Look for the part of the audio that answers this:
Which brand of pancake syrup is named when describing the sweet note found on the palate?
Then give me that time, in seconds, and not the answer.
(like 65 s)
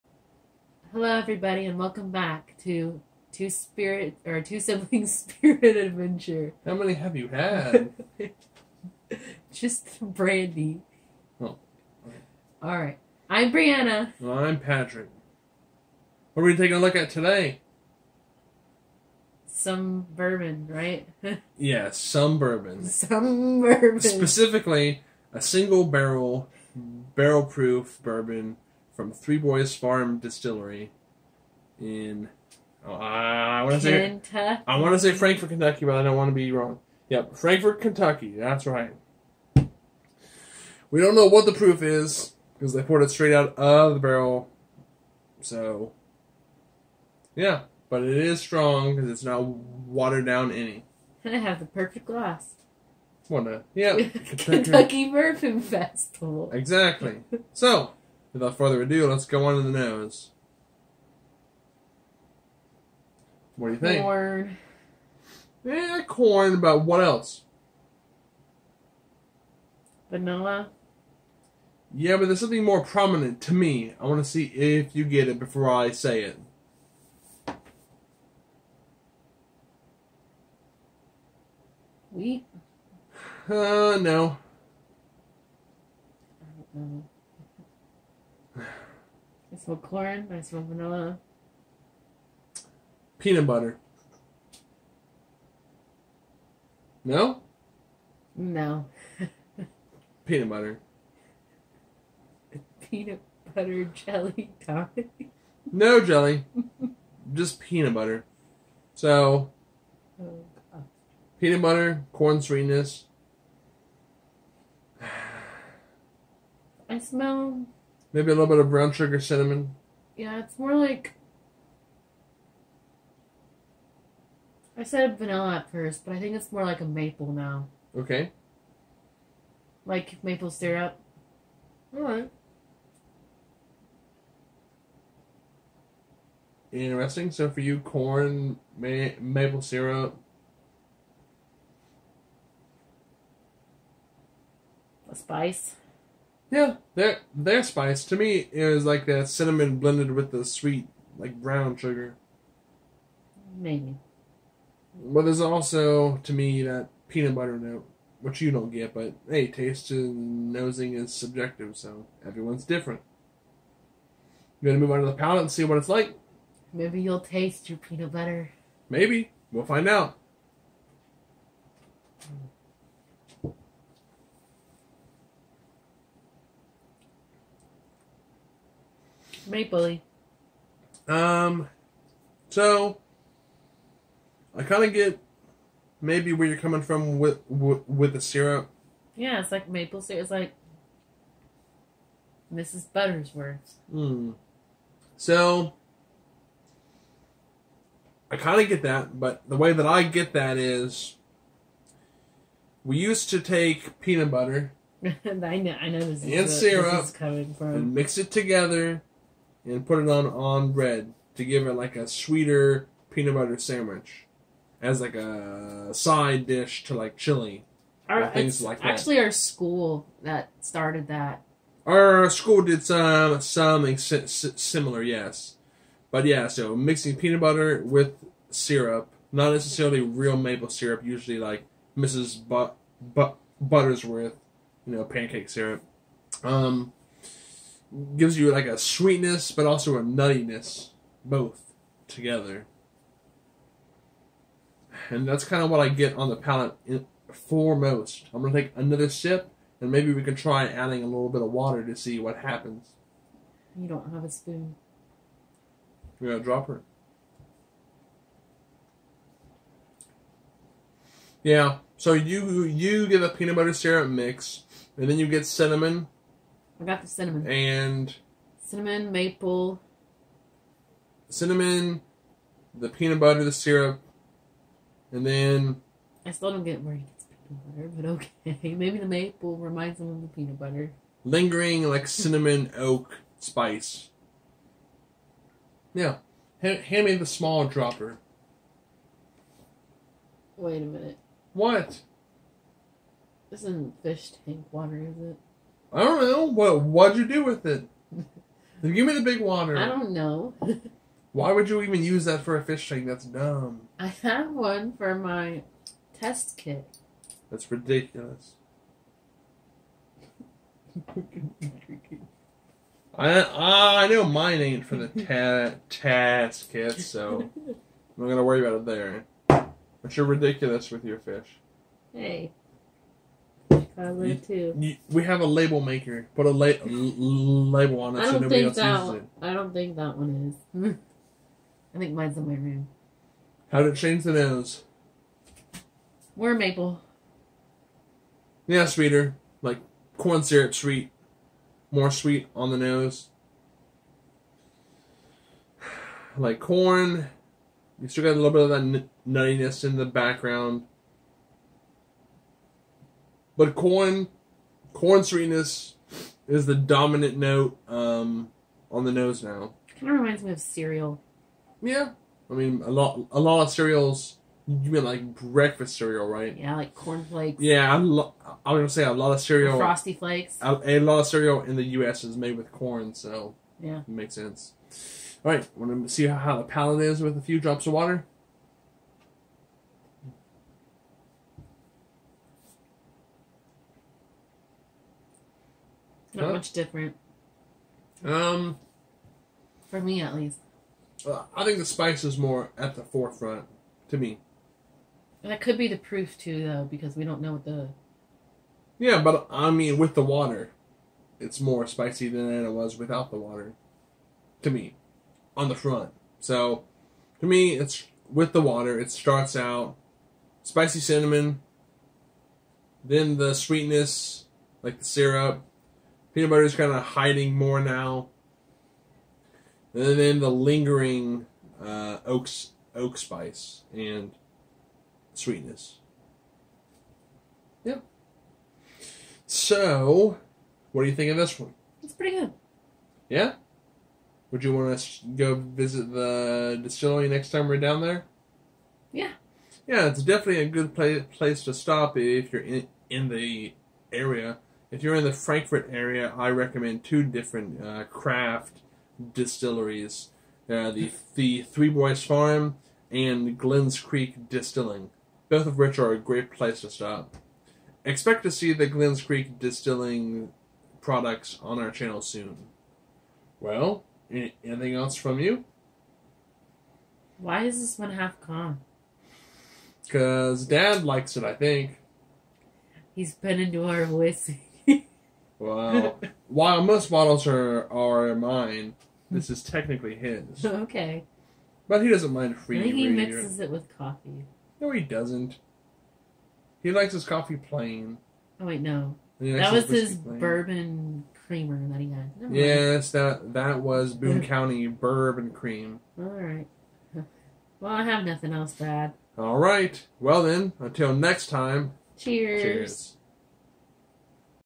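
192 s.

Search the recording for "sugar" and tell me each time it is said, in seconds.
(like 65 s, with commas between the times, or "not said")
118 s, 151 s.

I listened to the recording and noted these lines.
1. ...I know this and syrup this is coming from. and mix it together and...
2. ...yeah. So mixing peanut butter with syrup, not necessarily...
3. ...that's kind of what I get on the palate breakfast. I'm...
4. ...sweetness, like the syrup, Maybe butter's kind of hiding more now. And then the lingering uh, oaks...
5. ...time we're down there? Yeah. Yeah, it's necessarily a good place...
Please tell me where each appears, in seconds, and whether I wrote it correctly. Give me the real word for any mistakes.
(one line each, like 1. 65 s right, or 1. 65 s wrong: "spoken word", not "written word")
1. 205 s right
2. 226 s right
3. 245 s wrong: "foremost", not "breakfast"
4. 413 s wrong: "Peanut", not "Maybe"
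5. 437 s wrong: "definitely", not "necessarily".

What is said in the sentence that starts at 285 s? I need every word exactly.
Now, hand, hand me the small dropper.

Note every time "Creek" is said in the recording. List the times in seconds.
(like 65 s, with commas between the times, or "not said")
454 s, 459 s.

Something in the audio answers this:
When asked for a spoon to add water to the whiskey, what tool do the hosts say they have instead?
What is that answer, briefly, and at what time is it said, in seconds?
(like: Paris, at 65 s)
a dropper, at 256 s.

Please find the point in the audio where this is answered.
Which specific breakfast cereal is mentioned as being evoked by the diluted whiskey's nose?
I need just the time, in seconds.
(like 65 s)
366 s.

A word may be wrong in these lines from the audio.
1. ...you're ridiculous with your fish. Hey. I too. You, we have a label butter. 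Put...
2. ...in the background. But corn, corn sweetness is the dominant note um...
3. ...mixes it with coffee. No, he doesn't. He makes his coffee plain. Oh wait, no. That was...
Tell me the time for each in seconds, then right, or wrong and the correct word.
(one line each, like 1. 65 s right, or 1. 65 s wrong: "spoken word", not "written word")
1. 320 s wrong: "maker", not "butter"
2. 349 s right
3. 483 s wrong: "likes", not "makes".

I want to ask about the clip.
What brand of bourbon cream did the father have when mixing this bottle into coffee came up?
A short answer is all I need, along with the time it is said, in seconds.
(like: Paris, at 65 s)
Boone County, at 494 s.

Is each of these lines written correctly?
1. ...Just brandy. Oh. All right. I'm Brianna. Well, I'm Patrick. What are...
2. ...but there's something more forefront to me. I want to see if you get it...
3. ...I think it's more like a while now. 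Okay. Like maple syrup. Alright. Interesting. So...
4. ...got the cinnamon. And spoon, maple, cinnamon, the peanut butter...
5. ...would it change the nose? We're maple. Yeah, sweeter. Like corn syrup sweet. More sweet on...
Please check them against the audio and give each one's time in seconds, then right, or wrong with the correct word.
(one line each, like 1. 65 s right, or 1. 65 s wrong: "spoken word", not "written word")
1. 9 s right
2. 72 s wrong: "prominent", not "forefront"
3. 126 s wrong: "maple", not "while"
4. 266 s wrong: "cinnamon", not "spoon"
5. 333 s right.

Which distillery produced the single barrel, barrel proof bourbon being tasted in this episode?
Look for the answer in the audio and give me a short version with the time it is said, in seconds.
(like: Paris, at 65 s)
Three Boys Farm Distillery, at 29 s.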